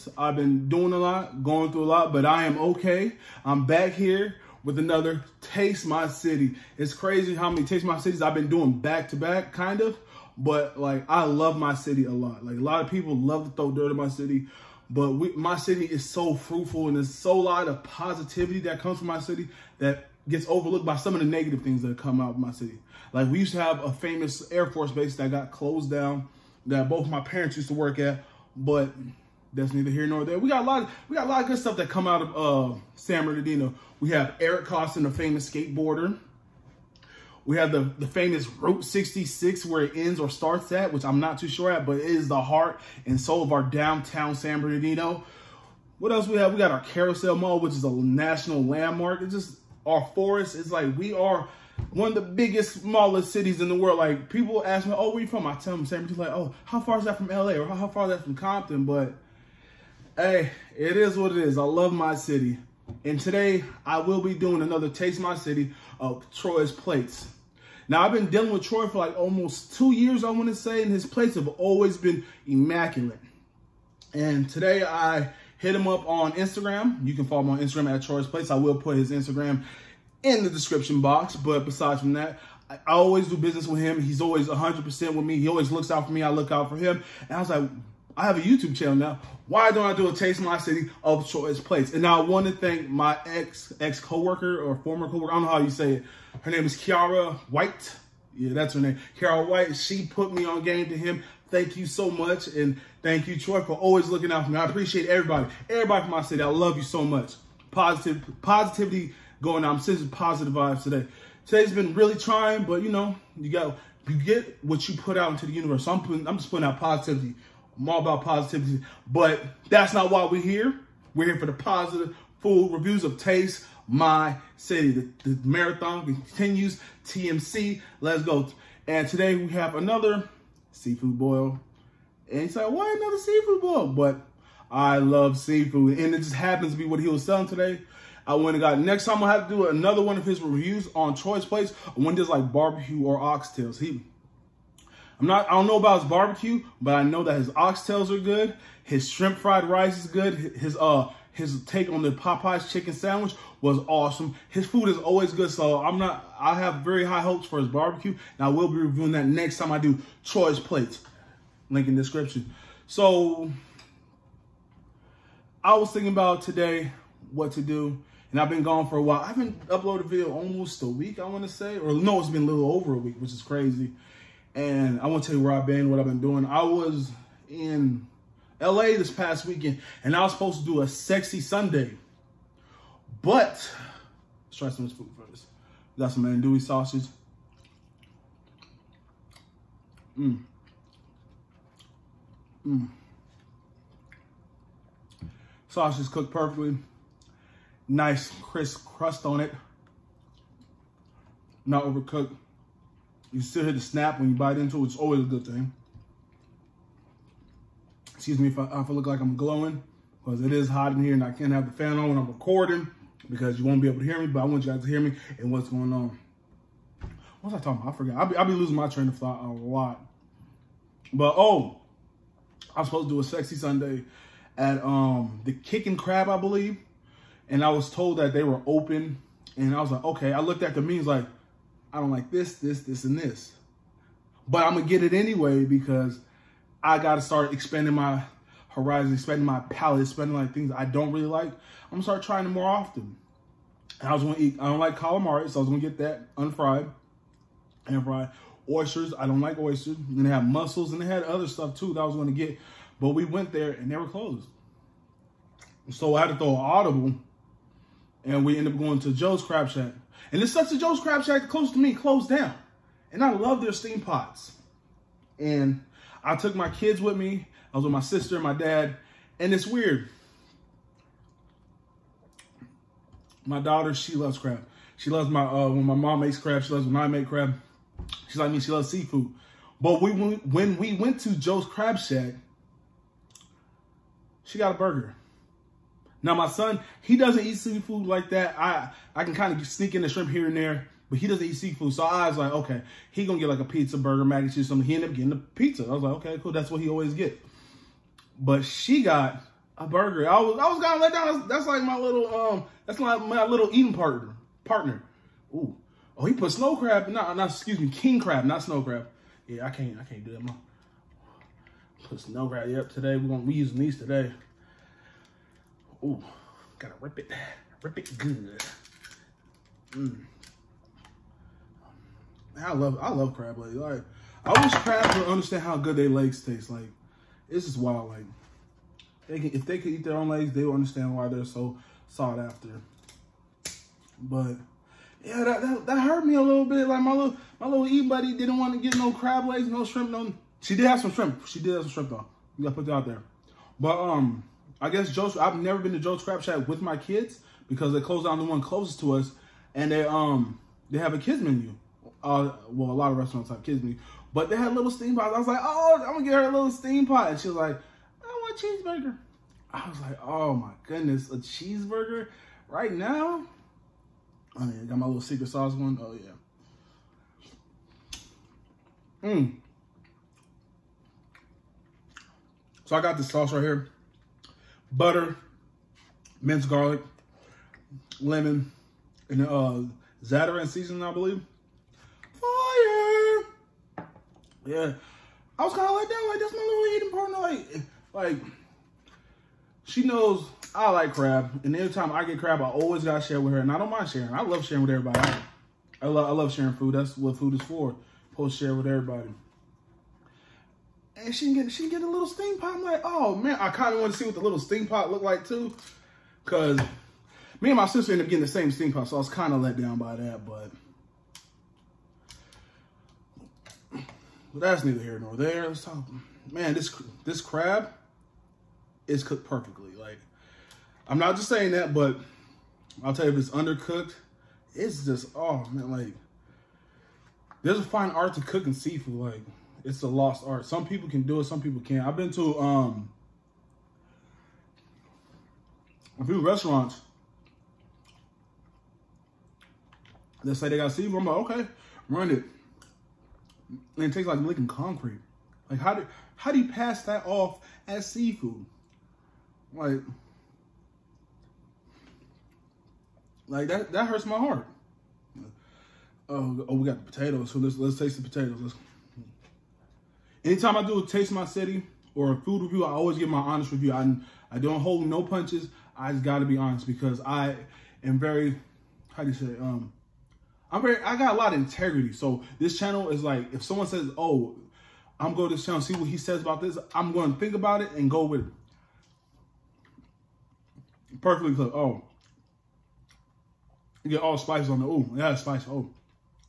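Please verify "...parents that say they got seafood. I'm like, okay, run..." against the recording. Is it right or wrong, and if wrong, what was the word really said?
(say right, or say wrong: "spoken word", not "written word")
wrong: "restaurants", not "parents".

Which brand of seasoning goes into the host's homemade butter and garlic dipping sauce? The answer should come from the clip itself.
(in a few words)
Zatarain.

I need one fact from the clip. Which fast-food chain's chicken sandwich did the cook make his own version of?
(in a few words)
Popeyes.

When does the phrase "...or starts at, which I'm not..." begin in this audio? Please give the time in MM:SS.
00:40.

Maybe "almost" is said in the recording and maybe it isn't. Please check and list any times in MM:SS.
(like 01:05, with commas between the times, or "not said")
01:09, 02:50.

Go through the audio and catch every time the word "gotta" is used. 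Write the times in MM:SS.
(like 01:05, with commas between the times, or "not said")
03:56, 05:16, 05:42.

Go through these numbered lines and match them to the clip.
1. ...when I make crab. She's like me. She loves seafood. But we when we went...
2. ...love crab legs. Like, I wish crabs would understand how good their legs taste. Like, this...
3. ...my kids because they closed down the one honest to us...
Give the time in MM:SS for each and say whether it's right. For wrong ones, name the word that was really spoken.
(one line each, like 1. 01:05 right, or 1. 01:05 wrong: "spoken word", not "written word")
1. 04:36 right
2. 05:23 right
3. 05:46 wrong: "closest", not "honest".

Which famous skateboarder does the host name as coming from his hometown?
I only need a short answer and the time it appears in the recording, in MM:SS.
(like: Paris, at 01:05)
Eric Koston, at 00:34.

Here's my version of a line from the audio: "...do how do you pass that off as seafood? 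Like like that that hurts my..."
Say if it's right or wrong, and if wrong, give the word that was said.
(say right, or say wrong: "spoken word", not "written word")
right.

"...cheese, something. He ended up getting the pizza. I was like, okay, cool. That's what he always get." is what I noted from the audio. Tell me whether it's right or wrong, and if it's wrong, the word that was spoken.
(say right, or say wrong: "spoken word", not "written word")
right.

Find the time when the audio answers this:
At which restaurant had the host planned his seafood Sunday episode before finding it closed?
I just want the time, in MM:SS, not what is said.
03:45.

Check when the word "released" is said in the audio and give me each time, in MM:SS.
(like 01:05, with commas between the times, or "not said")
not said.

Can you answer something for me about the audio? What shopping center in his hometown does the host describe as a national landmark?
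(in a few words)
Carousel Mall.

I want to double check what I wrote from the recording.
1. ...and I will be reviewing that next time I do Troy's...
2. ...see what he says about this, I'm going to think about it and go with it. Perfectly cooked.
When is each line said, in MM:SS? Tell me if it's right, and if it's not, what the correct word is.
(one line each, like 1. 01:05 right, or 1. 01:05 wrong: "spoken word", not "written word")
1. 02:38 right
2. 07:55 right.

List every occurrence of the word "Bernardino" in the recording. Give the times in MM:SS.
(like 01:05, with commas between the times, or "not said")
00:33, 00:44, 00:56.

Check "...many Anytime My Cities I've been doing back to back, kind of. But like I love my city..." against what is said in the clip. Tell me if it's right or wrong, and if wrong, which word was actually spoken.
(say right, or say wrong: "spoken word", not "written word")
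wrong: "Taste", not "Anytime".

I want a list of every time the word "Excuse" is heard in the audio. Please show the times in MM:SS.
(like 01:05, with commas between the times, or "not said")
03:28, 05:07.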